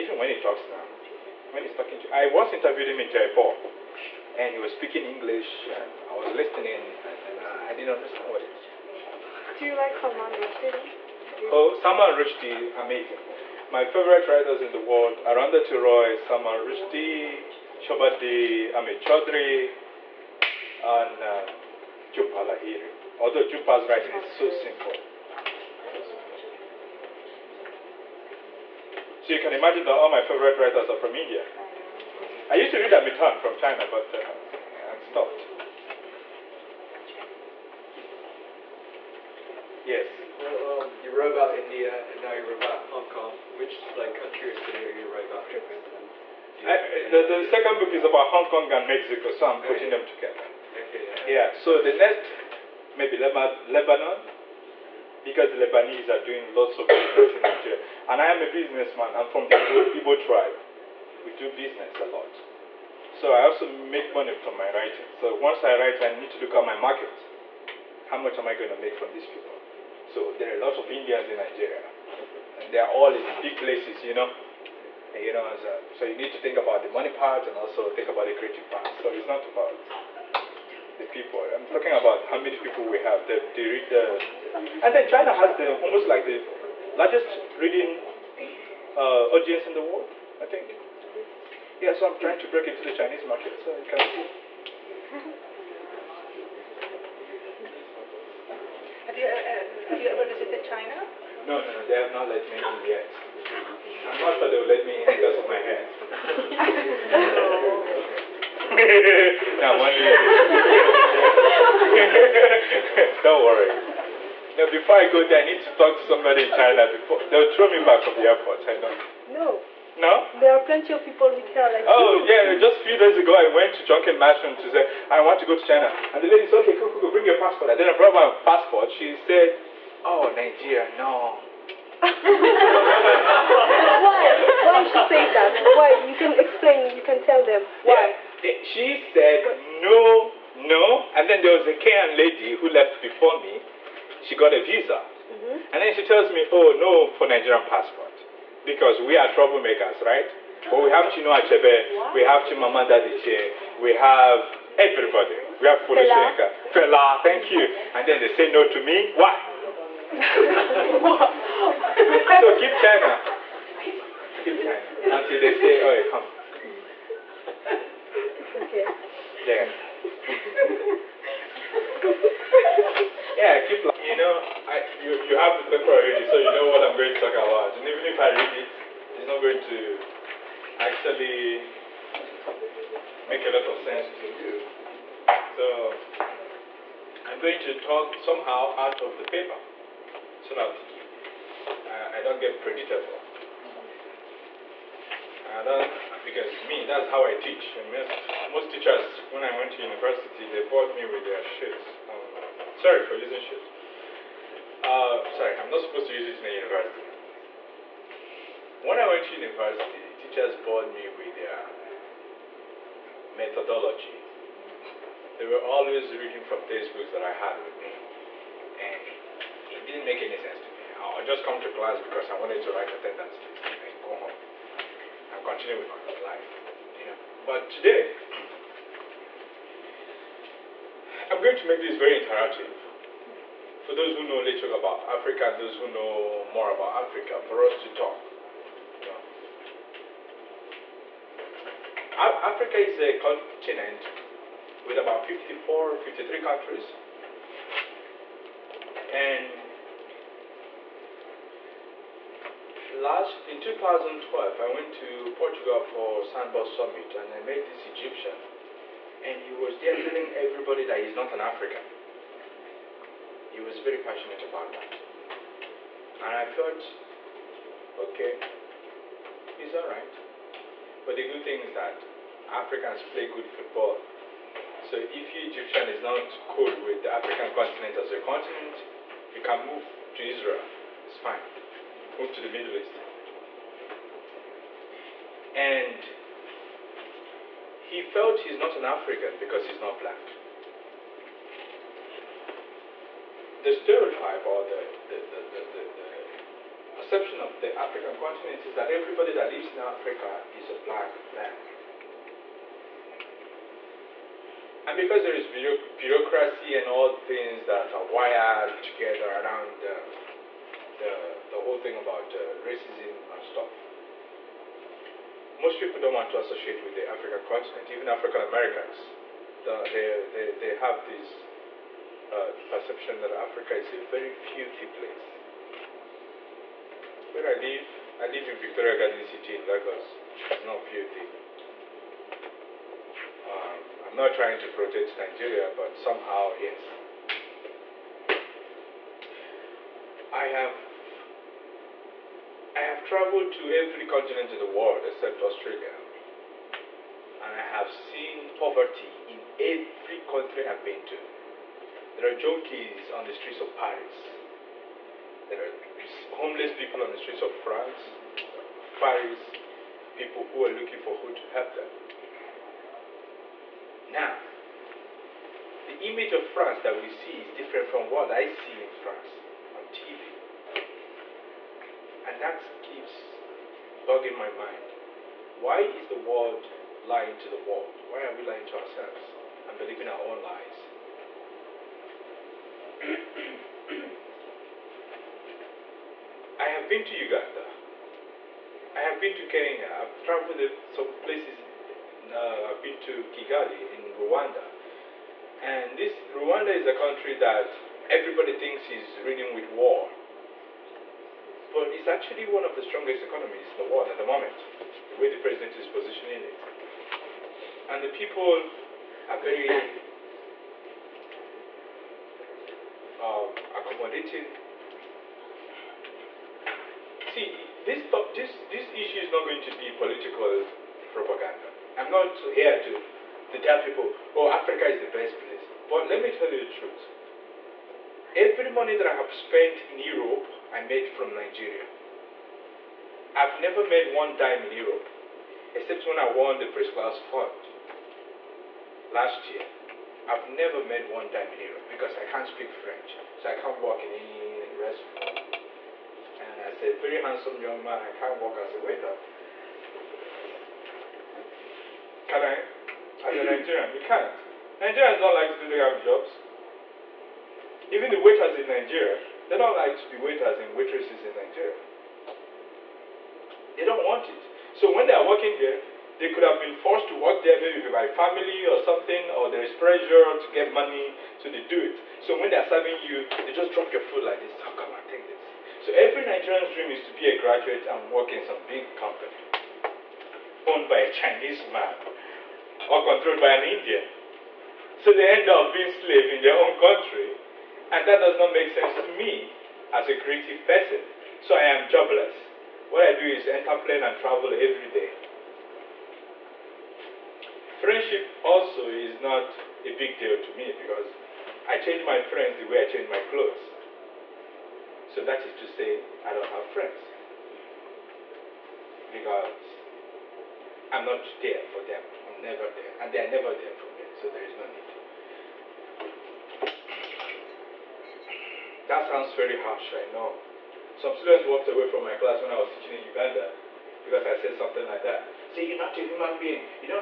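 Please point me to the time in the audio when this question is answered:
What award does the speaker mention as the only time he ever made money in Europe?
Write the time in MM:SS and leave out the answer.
07:16.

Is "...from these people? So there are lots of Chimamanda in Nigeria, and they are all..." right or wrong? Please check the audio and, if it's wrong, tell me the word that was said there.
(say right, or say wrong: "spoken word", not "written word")
wrong: "Indians", not "Chimamanda".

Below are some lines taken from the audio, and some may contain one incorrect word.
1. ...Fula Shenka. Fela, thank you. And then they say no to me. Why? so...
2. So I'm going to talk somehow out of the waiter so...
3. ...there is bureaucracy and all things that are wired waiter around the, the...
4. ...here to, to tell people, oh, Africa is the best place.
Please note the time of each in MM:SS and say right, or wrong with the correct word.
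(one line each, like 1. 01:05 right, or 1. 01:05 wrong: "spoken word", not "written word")
1. 02:35 right
2. 03:05 wrong: "paper", not "waiter"
3. 05:05 wrong: "together", not "waiter"
4. 07:02 right.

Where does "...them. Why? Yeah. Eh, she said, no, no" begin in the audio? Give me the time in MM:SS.
02:17.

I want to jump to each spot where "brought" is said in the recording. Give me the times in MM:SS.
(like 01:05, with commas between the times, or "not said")
02:07.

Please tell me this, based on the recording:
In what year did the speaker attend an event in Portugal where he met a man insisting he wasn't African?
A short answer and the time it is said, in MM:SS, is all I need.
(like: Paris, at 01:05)
2012, at 04:13.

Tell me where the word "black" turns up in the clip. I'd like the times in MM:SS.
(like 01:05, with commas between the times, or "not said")
04:49, 05:00.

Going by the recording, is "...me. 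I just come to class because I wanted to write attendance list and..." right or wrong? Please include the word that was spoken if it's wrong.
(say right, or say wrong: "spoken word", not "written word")
right.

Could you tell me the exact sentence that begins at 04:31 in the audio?
But the good thing is that Africans play good football.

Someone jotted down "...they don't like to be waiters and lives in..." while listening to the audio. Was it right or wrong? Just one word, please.
wrong.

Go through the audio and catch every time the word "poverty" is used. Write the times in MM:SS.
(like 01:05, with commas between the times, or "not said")
05:48.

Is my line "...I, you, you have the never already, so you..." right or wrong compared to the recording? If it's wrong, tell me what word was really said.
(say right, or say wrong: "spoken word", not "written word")
wrong: "paper", not "never".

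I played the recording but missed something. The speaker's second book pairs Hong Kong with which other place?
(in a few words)
Mexico.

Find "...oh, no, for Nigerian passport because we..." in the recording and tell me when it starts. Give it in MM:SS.
02:26.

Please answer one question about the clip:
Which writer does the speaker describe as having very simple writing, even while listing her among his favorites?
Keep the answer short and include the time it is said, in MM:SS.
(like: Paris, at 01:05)
Jhumpa Lahiri, at 00:22.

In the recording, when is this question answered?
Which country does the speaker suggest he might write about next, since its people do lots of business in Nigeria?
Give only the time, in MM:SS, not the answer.
00:53.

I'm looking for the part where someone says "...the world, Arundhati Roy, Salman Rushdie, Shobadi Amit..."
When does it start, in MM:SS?
00:14.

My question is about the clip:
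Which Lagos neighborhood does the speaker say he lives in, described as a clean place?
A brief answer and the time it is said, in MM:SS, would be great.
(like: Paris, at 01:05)
Victoria Garden City, at 05:28.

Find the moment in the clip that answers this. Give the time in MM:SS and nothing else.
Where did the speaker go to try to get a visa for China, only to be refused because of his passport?
02:03.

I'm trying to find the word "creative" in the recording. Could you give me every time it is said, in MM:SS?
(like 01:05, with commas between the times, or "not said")
01:18, 08:10.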